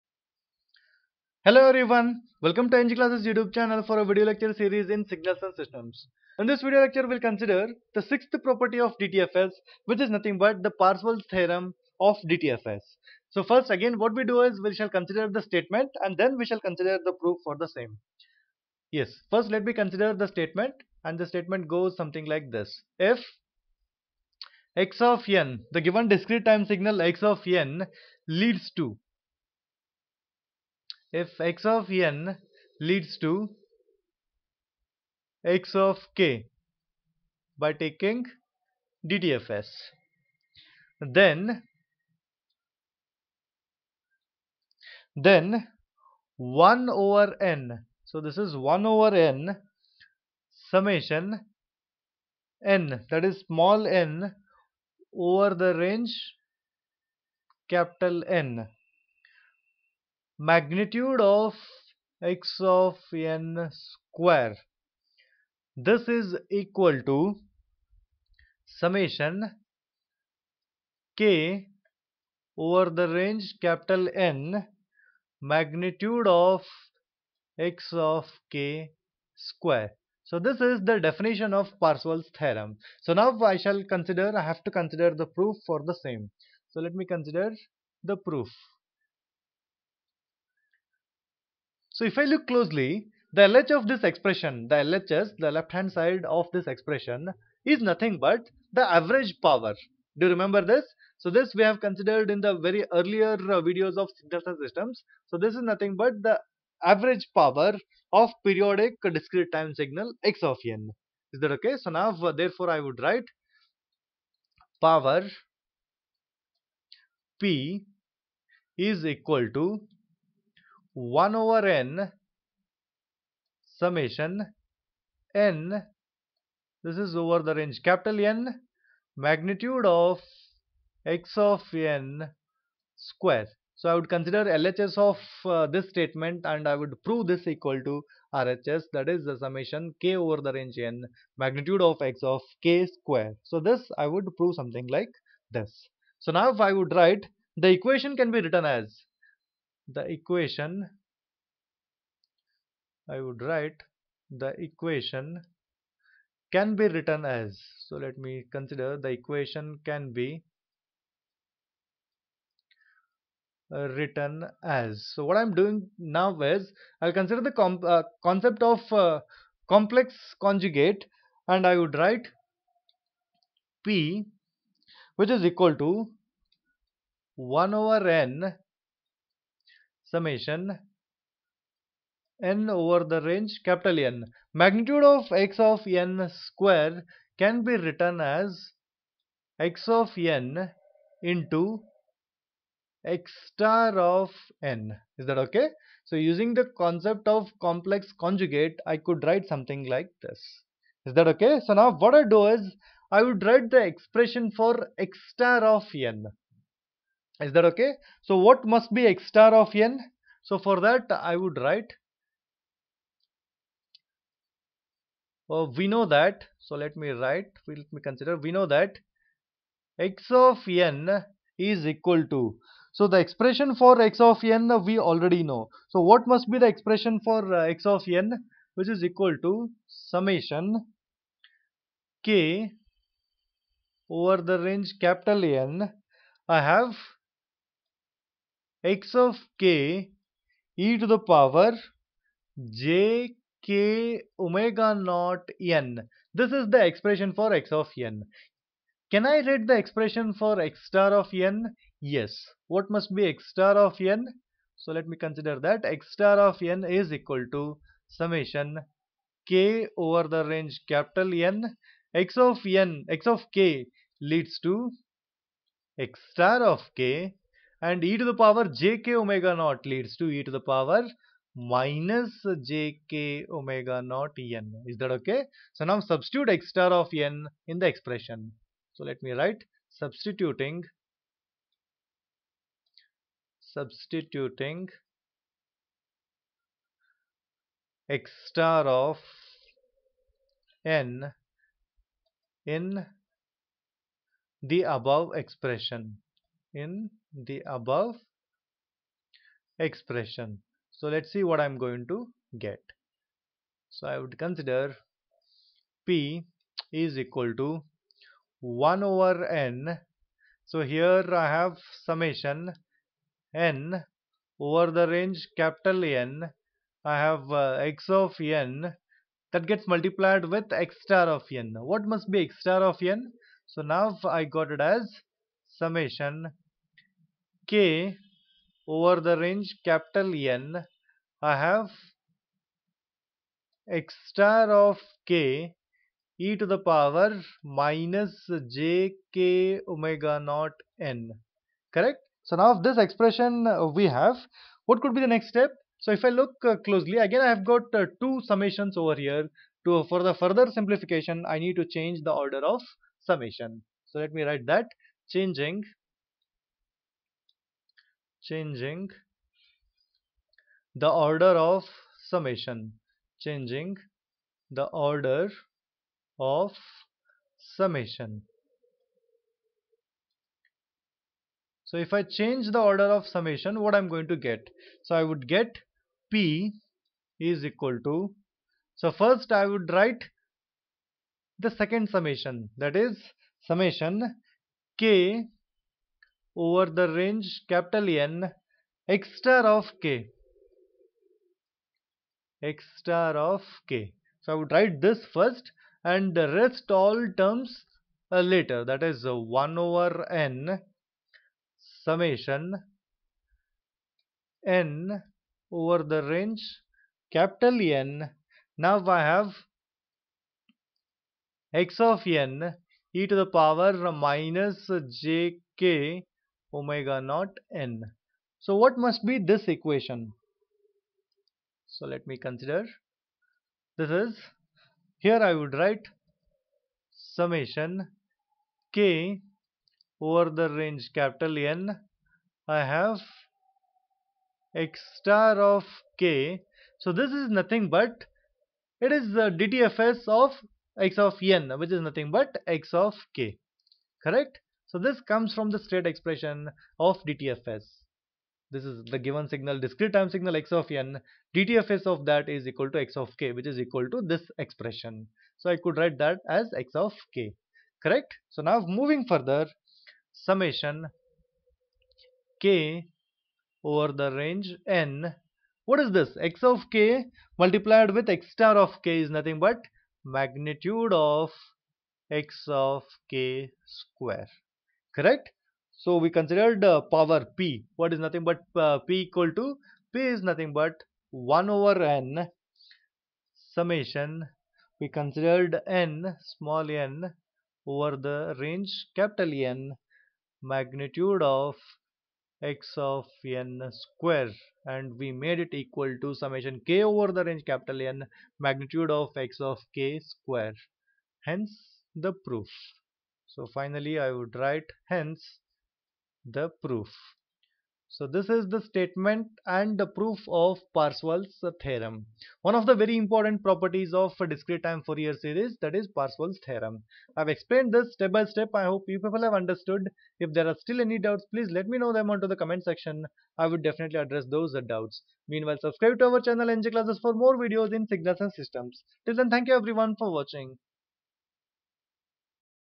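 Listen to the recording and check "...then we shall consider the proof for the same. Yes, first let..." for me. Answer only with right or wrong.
right.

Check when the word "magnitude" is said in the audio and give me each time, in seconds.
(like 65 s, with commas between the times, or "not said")
60 s, 75 s, 129 s, 141 s, 184 s, 470 s, 490 s, 498 s.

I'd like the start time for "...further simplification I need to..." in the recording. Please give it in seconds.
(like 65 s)
350 s.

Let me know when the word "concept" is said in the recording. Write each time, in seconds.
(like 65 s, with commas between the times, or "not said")
168 s, 196 s.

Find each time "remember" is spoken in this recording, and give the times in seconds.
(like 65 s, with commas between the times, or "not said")
100 s.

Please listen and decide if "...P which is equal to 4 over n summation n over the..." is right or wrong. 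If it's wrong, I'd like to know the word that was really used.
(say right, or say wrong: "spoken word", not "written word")
wrong: "1", not "4".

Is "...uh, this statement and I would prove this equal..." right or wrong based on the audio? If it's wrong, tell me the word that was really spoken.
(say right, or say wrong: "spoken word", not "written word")
right.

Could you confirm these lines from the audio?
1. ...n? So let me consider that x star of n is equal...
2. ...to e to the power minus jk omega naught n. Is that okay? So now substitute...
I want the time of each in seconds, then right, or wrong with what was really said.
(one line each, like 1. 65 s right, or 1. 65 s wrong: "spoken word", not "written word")
1. 254 s right
2. 270 s right.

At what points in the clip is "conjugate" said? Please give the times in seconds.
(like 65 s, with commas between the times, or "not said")
170 s, 198 s.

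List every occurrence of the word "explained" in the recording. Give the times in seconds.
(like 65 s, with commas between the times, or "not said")
517 s.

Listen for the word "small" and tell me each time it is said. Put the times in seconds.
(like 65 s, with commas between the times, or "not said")
53 s, 486 s.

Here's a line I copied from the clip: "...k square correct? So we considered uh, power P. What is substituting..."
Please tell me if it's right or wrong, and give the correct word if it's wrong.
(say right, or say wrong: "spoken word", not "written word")
wrong: "nothing", not "substituting".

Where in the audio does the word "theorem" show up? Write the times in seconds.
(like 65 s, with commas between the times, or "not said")
11 s, 82 s, 511 s, 516 s.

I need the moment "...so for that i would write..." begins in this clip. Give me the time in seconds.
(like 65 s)
210 s.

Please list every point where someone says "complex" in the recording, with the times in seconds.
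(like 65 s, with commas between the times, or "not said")
169 s, 197 s.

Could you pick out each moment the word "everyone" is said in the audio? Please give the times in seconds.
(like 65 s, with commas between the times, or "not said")
1 s, 529 s.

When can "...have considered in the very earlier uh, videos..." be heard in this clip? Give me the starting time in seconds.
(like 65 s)
101 s.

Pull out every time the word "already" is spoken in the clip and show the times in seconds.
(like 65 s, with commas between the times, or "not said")
224 s.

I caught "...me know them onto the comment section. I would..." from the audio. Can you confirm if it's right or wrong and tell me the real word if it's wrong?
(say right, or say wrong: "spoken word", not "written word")
right.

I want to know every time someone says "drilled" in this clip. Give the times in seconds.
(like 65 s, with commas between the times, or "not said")
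not said.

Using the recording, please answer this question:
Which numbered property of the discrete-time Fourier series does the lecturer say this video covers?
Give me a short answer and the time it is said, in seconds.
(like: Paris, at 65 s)
Sixth, at 8 s.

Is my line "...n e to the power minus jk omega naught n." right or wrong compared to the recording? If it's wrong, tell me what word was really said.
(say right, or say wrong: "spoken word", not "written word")
right.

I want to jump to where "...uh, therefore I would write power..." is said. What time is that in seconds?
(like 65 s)
112 s.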